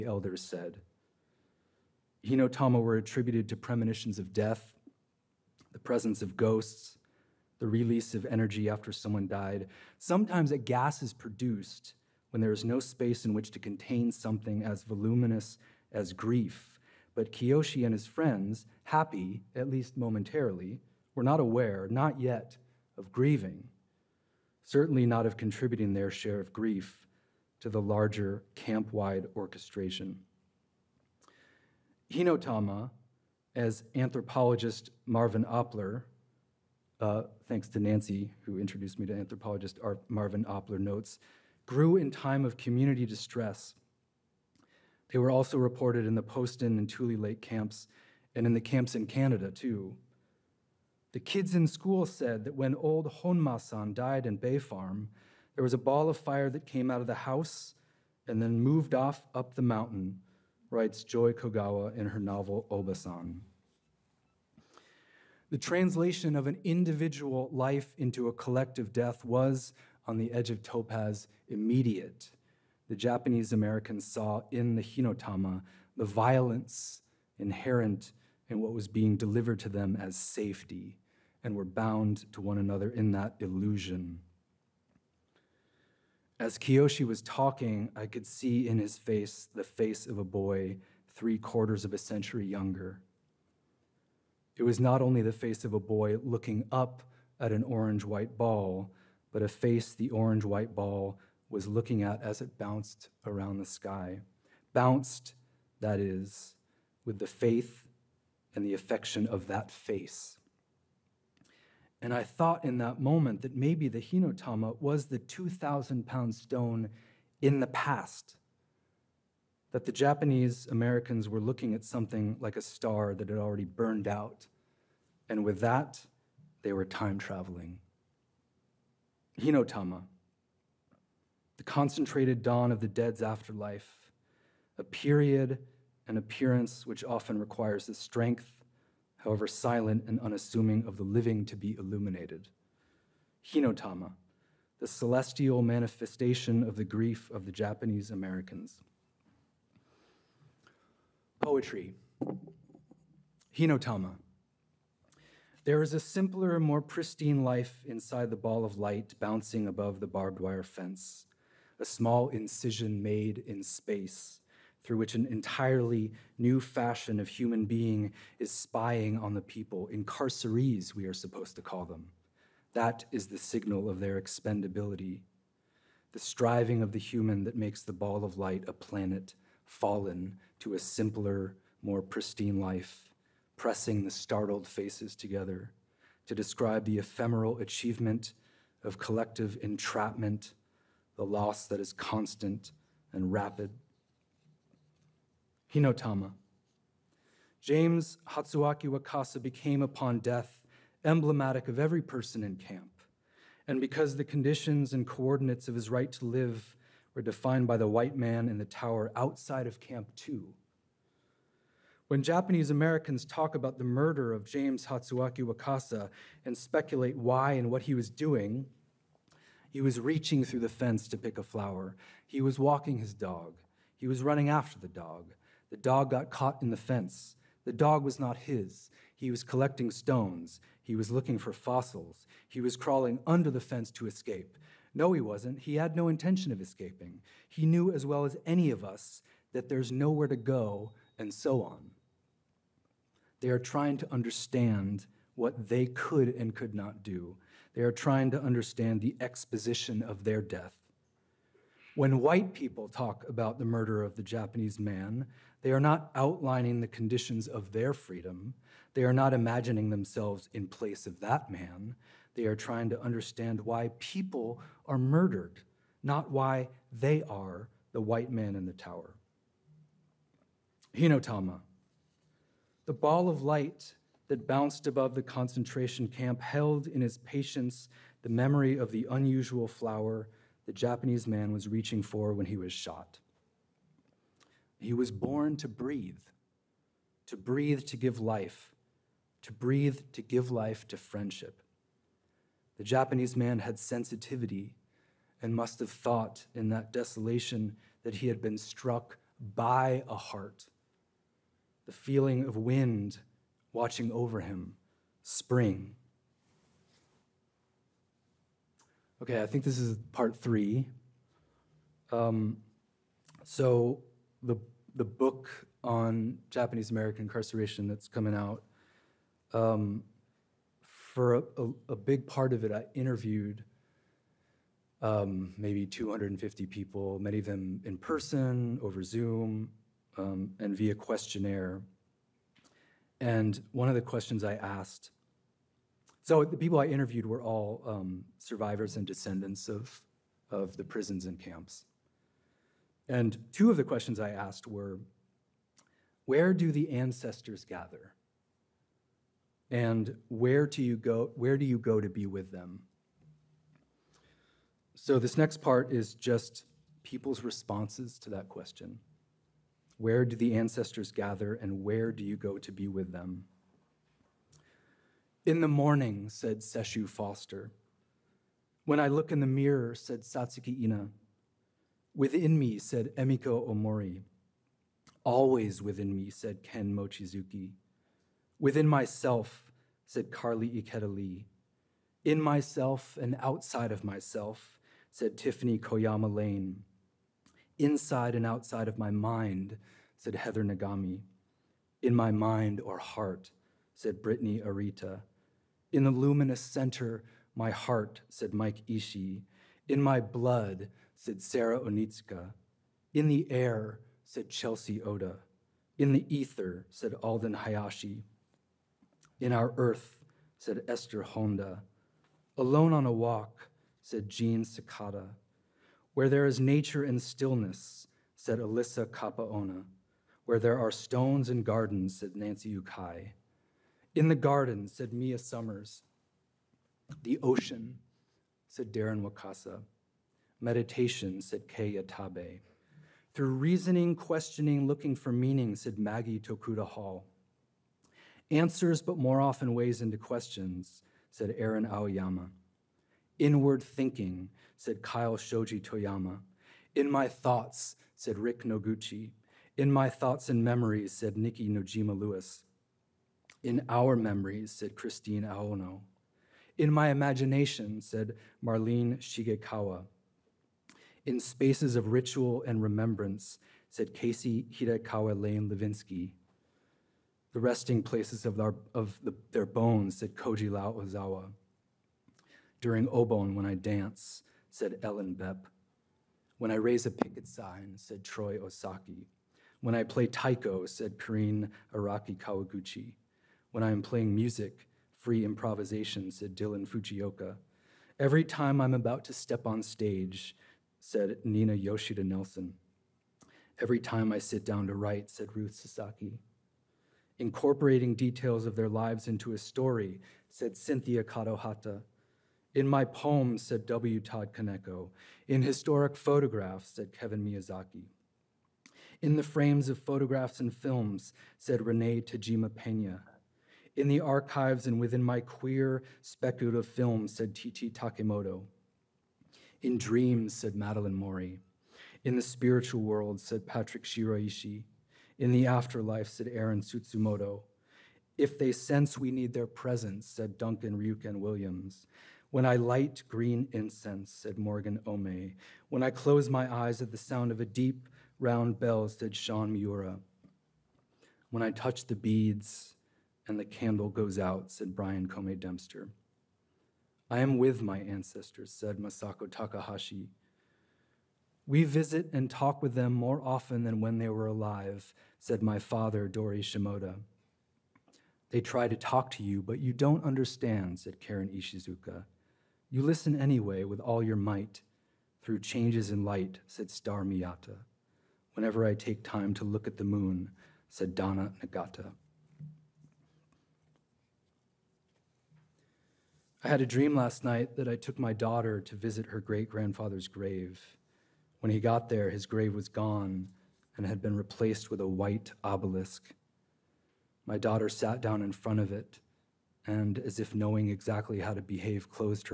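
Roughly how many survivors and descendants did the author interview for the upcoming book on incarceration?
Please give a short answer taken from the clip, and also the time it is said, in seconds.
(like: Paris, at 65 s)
250, at 325 s.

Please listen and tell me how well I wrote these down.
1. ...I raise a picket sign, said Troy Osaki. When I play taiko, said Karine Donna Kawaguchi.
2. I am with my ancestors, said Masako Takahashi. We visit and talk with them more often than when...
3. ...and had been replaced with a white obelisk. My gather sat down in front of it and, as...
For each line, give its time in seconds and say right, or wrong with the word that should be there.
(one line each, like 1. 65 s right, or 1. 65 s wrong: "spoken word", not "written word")
1. 476 s wrong: "Araki", not "Donna"
2. 547 s right
3. 583 s wrong: "daughter", not "gather".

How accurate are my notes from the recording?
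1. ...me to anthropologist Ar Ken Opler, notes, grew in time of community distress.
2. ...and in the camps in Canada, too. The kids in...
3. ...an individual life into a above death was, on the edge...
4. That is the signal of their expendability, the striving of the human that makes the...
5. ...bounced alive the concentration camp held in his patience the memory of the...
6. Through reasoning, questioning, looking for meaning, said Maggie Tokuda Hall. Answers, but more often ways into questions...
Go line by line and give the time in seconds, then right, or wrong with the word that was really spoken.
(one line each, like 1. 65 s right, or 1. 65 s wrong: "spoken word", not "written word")
1. 38 s wrong: "Marvin", not "Ken"
2. 48 s right
3. 66 s wrong: "collective", not "above"
4. 172 s right
5. 274 s wrong: "above", not "alive"
6. 433 s right.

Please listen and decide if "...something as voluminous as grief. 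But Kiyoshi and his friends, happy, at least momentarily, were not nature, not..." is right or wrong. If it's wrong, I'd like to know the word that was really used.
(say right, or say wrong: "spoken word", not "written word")
wrong: "aware", not "nature".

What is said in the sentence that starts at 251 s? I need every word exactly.
When white people talk about the murder of the Japanese man, they are not outlining the conditions of their freedom.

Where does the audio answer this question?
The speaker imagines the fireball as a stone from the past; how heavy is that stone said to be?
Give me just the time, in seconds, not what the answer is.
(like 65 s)
115 s.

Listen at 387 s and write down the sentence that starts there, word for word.
Inside and outside of my mind, said Heather Nagami.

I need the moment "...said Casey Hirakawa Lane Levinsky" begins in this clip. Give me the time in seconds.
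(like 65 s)
463 s.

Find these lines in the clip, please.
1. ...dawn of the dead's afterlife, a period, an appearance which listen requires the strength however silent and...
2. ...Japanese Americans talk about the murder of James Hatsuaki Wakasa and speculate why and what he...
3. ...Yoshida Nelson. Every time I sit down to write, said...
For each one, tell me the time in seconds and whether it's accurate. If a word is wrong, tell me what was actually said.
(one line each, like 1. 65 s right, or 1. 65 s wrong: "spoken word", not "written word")
1. 132 s wrong: "often", not "listen"
2. 212 s right
3. 491 s right.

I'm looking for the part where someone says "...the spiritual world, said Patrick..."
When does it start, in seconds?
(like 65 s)
522 s.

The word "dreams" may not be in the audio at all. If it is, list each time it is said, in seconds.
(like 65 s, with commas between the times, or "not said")
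519 s, 576 s.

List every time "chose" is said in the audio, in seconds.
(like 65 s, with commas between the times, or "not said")
not said.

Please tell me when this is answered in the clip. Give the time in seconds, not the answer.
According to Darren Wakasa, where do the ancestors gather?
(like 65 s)
427 s.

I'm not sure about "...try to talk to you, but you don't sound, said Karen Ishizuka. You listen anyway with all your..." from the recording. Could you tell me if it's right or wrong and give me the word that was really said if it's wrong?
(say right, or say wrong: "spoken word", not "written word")
wrong: "understand", not "sound".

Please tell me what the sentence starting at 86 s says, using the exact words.
As Kiyoshi was talking, I could see in his face the face of a boy three quarters of a century younger.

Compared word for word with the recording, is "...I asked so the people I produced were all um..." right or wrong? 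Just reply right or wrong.
wrong.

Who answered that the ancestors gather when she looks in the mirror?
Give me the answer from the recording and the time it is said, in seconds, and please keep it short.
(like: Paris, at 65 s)
Satsuki Ina, at 370 s.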